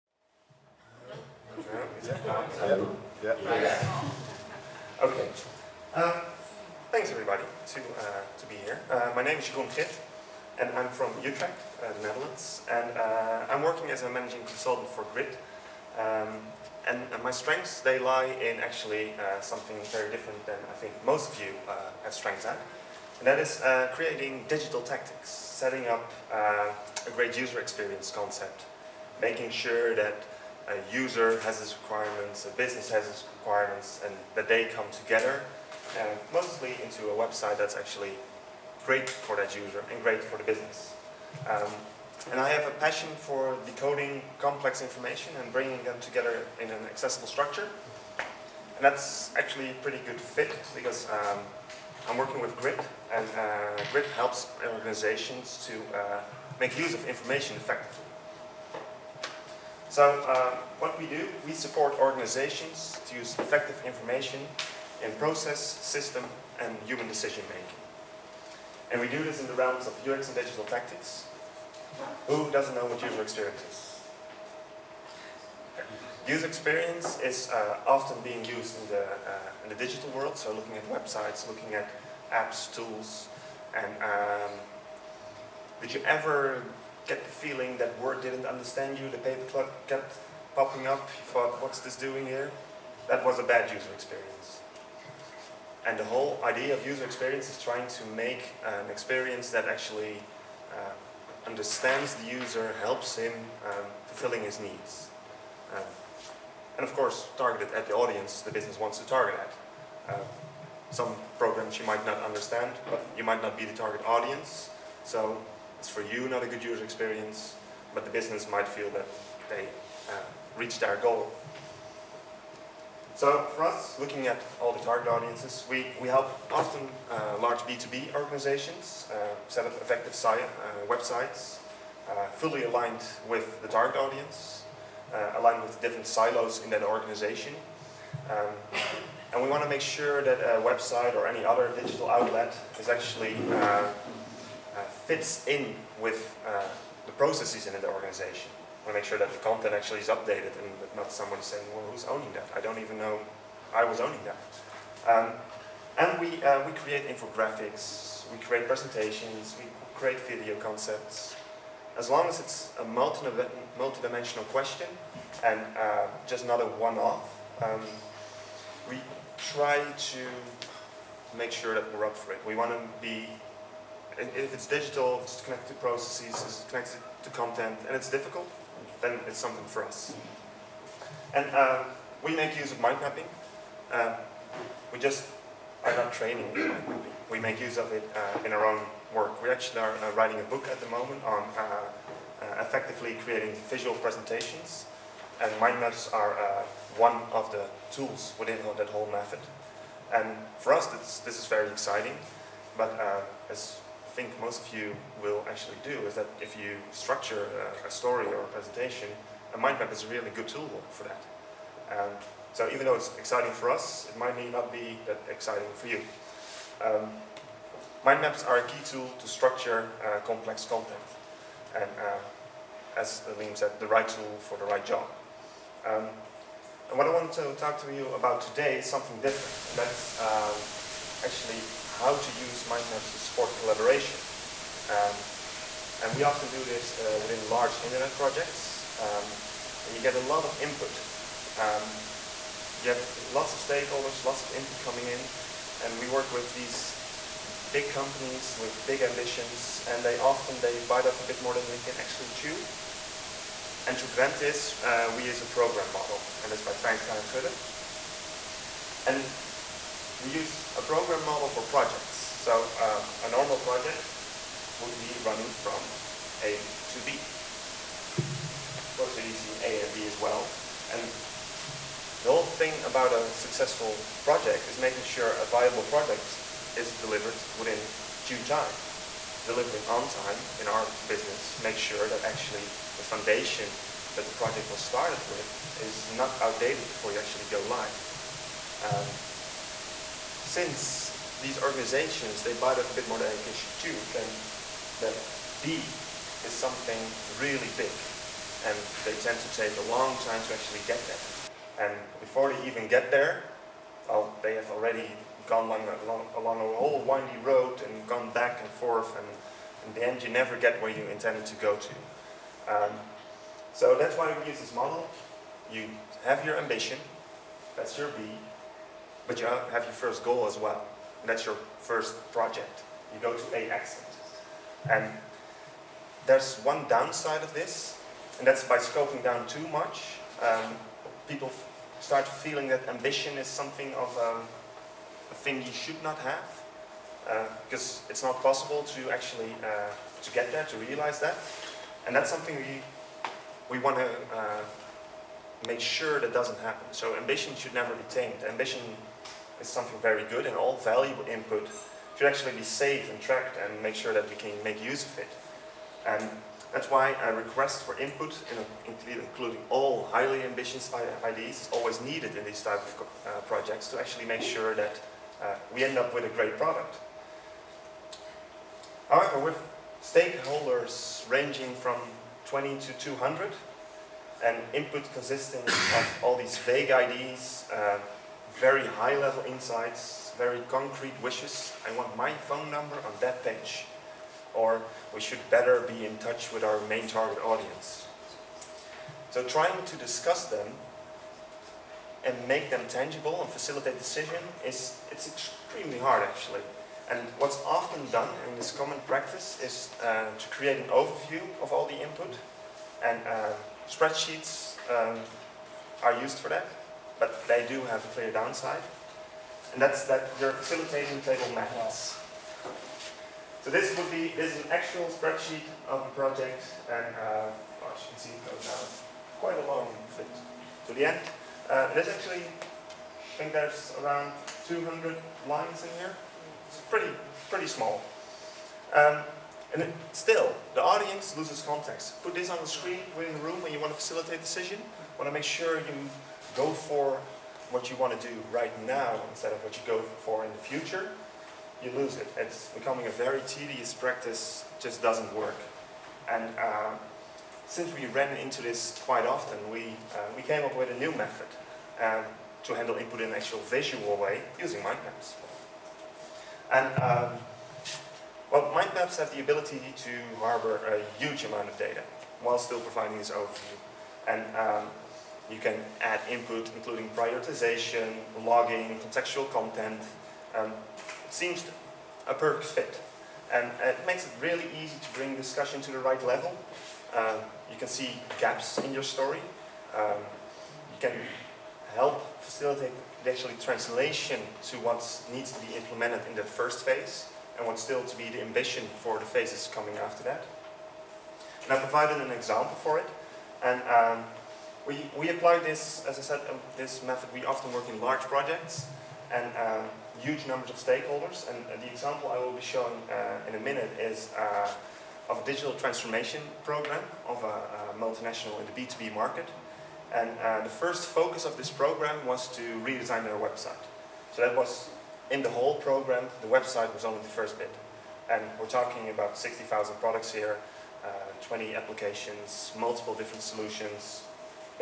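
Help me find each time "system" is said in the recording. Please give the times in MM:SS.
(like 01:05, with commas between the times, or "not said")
01:05.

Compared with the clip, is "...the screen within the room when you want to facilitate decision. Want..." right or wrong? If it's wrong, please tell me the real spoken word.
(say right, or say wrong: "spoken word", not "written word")
right.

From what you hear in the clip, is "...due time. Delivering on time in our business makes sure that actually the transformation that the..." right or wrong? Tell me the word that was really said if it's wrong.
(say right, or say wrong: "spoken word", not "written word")
wrong: "foundation", not "transformation".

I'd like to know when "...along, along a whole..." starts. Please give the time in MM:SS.
05:06.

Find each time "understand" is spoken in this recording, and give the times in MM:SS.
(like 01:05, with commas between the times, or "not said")
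01:28, 01:41, 01:52.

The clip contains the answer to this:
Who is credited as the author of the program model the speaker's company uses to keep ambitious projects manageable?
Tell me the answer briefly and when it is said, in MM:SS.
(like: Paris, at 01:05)
Twynstra and Gudde, at 04:16.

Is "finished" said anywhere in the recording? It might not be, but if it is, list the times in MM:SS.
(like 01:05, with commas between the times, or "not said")
not said.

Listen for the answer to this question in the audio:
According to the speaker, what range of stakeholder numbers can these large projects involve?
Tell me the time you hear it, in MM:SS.
06:12.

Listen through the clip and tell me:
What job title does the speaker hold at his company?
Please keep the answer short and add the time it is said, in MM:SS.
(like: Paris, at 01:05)
Managing consultant, at 00:14.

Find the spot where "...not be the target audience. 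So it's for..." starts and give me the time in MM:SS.
01:53.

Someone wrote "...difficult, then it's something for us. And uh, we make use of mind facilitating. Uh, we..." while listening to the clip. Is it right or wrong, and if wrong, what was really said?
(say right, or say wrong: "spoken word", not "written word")
wrong: "mapping", not "facilitating".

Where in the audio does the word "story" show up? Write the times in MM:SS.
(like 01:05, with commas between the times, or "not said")
03:27, 07:59.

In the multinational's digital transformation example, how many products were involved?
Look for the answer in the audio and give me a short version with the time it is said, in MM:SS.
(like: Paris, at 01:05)
60,000, at 08:39.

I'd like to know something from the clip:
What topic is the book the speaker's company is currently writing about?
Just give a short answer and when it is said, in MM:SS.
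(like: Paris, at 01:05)
Effectively creating visual presentations, at 03:12.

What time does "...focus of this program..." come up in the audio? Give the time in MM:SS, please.
08:31.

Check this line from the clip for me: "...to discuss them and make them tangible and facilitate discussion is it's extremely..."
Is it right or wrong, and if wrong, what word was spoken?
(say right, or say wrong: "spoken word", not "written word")
wrong: "decision", not "discussion".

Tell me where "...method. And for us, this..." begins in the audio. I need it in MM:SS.
03:19.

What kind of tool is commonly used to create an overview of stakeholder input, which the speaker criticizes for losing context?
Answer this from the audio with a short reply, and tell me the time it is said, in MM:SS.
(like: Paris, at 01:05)
Spreadsheets, at 06:43.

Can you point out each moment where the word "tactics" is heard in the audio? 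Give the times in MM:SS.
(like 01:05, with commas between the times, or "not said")
00:24, 01:10.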